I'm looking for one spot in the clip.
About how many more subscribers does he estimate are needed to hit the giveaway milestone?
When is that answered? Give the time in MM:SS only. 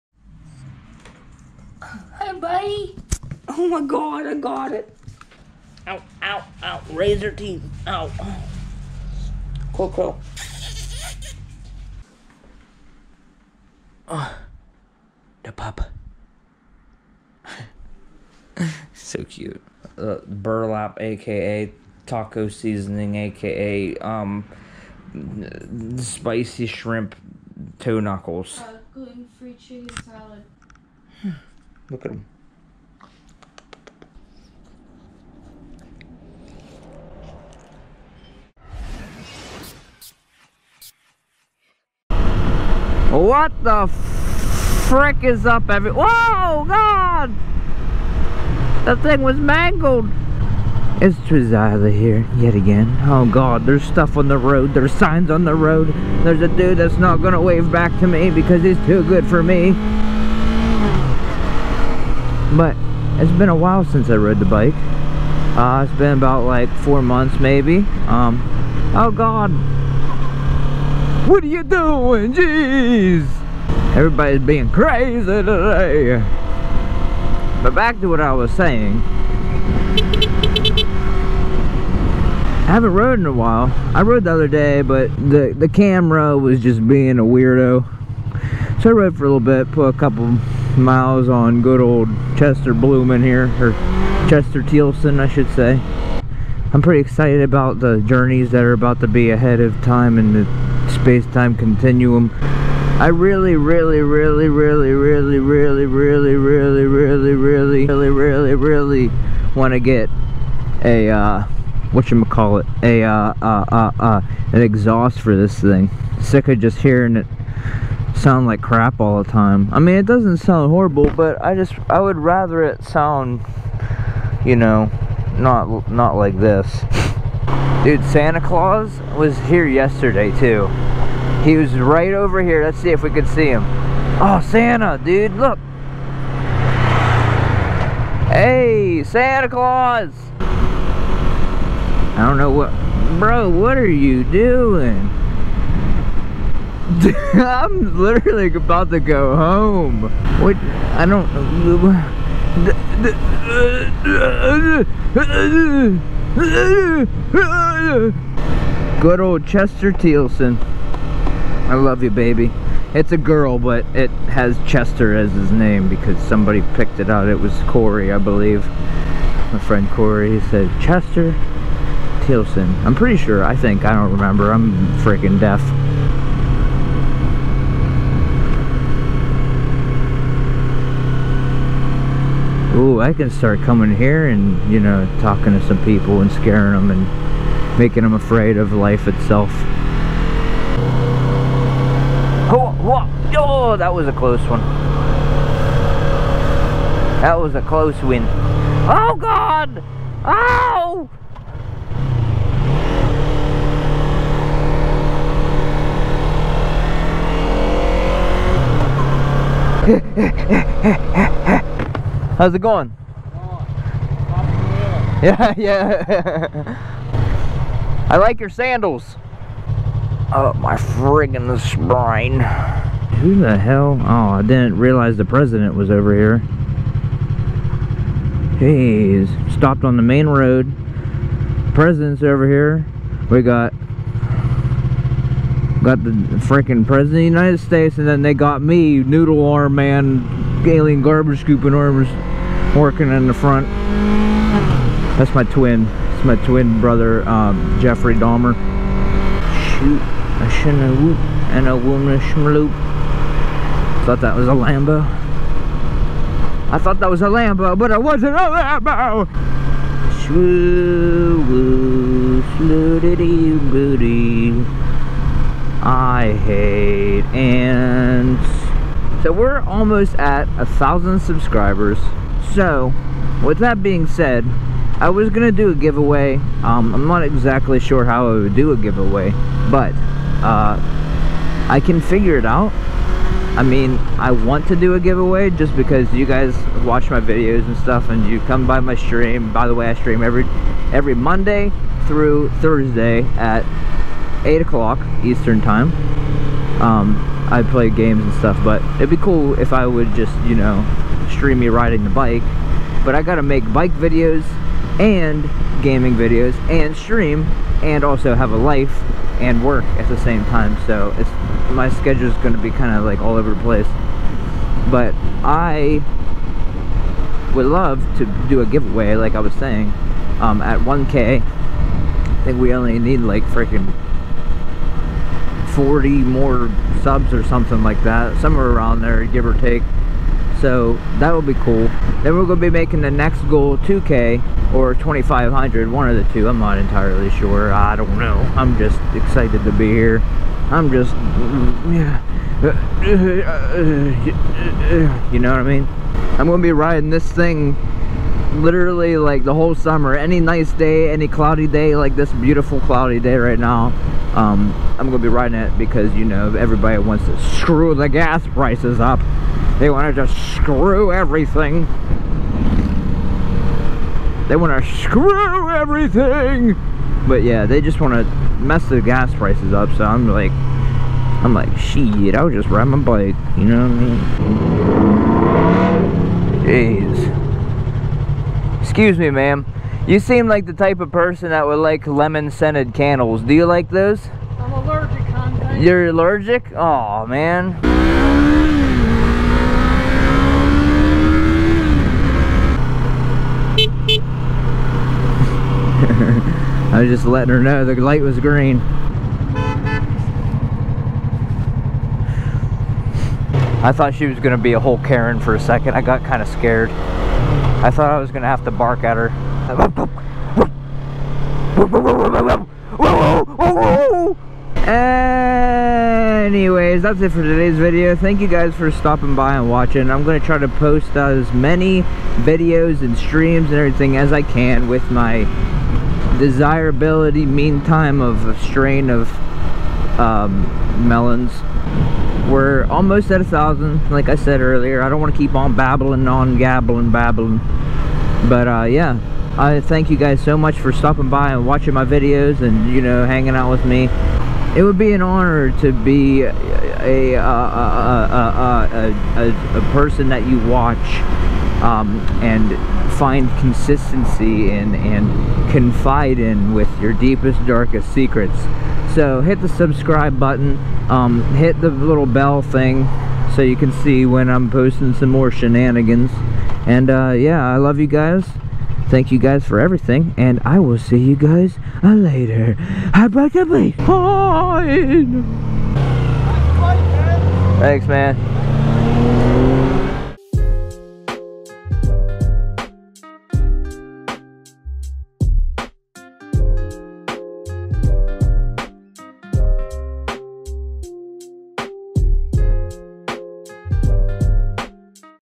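05:25.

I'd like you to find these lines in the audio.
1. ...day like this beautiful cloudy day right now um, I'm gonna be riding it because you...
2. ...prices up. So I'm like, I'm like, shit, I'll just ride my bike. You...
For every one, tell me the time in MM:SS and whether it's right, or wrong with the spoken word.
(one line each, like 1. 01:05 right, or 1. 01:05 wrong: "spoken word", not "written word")
1. 05:51 right
2. 06:09 right.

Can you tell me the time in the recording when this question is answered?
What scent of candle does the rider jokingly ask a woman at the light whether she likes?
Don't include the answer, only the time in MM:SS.
06:22.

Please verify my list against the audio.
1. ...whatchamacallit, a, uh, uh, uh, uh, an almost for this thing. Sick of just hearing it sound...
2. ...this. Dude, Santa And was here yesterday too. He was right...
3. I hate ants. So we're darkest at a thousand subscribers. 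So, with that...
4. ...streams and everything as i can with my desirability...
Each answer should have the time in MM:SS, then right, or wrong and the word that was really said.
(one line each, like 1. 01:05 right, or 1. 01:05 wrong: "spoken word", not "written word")
1. 01:51 wrong: "exhaust", not "almost"
2. 02:06 wrong: "Claus", not "And"
3. 04:25 wrong: "almost", not "darkest"
4. 07:03 right.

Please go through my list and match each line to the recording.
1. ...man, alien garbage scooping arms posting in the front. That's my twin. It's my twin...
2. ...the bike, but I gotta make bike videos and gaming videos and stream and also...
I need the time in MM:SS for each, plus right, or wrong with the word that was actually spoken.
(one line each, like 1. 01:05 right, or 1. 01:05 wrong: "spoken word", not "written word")
1. 03:59 wrong: "working", not "posting"
2. 05:02 right.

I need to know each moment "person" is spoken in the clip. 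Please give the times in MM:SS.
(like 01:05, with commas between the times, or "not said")
06:21, 07:29.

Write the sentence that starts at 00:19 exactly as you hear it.
Uh, burlap, aka taco seasoning, aka um, spicy shrimp toe knuckles.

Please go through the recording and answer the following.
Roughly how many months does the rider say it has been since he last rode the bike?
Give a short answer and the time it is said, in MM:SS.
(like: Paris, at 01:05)
4, at 01:06.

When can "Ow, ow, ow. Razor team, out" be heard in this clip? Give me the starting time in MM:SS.
00:05.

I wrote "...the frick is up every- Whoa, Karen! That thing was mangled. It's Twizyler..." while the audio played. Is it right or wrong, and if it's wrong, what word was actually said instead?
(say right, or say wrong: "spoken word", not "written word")
wrong: "God", not "Karen".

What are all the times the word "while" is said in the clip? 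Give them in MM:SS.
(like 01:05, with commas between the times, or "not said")
01:03, 01:23.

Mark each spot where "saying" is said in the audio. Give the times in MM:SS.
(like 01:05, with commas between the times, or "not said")
01:18, 05:19.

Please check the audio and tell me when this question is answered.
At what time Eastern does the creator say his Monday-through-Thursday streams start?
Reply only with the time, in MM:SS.
04:54.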